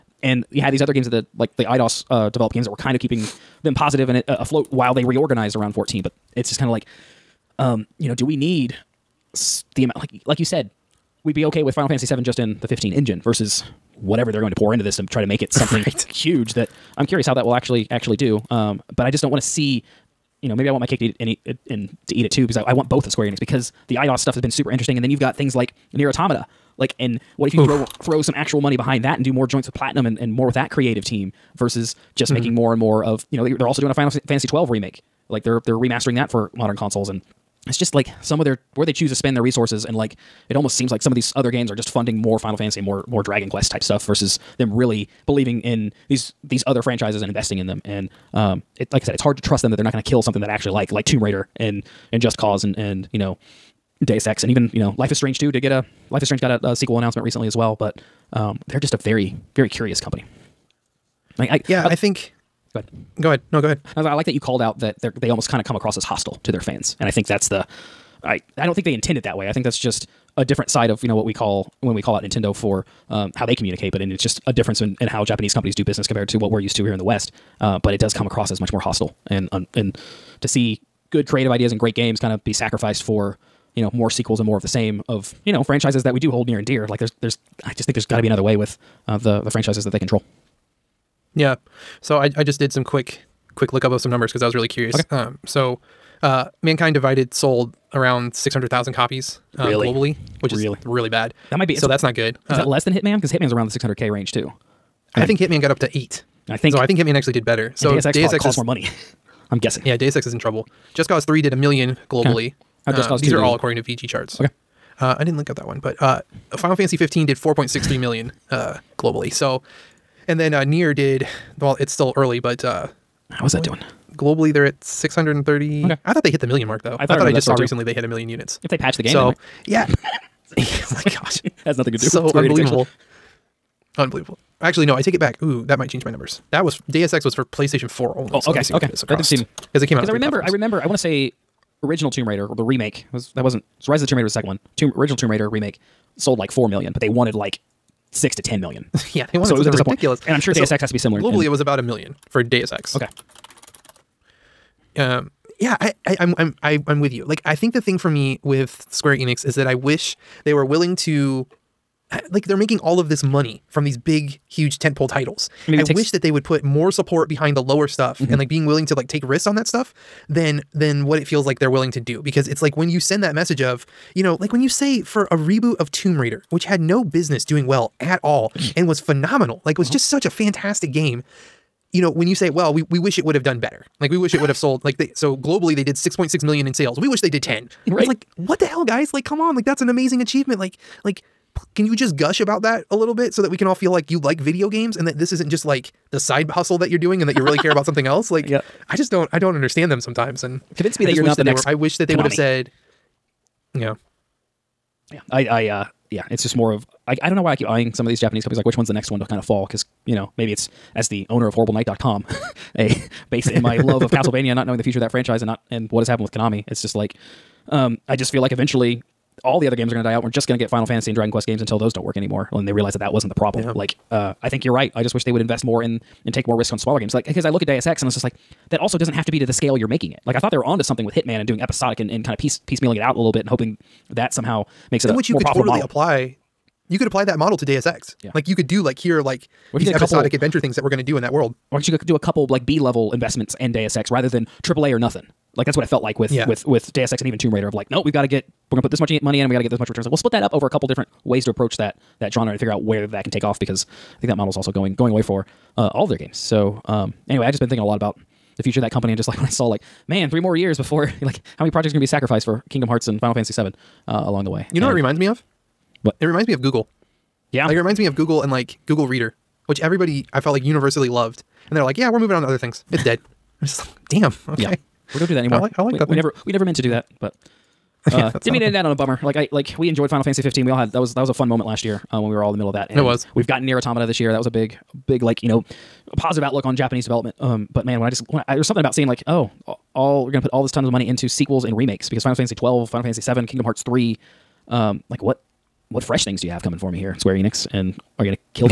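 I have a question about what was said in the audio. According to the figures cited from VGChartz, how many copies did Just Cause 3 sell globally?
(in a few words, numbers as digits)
1 million.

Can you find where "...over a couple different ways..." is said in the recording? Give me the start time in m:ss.
4:10.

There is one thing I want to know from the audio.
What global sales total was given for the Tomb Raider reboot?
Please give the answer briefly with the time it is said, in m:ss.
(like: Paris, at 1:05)
6.6 million, at 3:05.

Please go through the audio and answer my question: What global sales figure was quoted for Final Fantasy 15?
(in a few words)
4.63 million.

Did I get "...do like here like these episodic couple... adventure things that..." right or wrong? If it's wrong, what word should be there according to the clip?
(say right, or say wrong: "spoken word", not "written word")
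right.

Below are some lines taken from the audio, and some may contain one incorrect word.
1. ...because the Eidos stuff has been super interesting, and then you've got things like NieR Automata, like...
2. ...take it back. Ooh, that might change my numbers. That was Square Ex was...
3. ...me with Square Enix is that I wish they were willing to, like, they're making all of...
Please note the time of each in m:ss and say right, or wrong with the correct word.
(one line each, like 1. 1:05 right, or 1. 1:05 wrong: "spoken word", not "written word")
1. 0:23 right
2. 2:15 wrong: "Deus", not "Square"
3. 2:38 right.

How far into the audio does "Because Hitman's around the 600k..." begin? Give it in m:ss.
1:43.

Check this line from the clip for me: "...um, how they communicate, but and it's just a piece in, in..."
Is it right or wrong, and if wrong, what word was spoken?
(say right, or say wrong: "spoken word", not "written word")
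wrong: "difference", not "piece".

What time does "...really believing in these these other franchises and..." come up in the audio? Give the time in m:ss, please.
0:44.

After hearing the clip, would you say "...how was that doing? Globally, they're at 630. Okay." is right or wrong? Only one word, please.
right.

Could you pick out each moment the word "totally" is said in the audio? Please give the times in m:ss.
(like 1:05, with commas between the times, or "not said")
3:55.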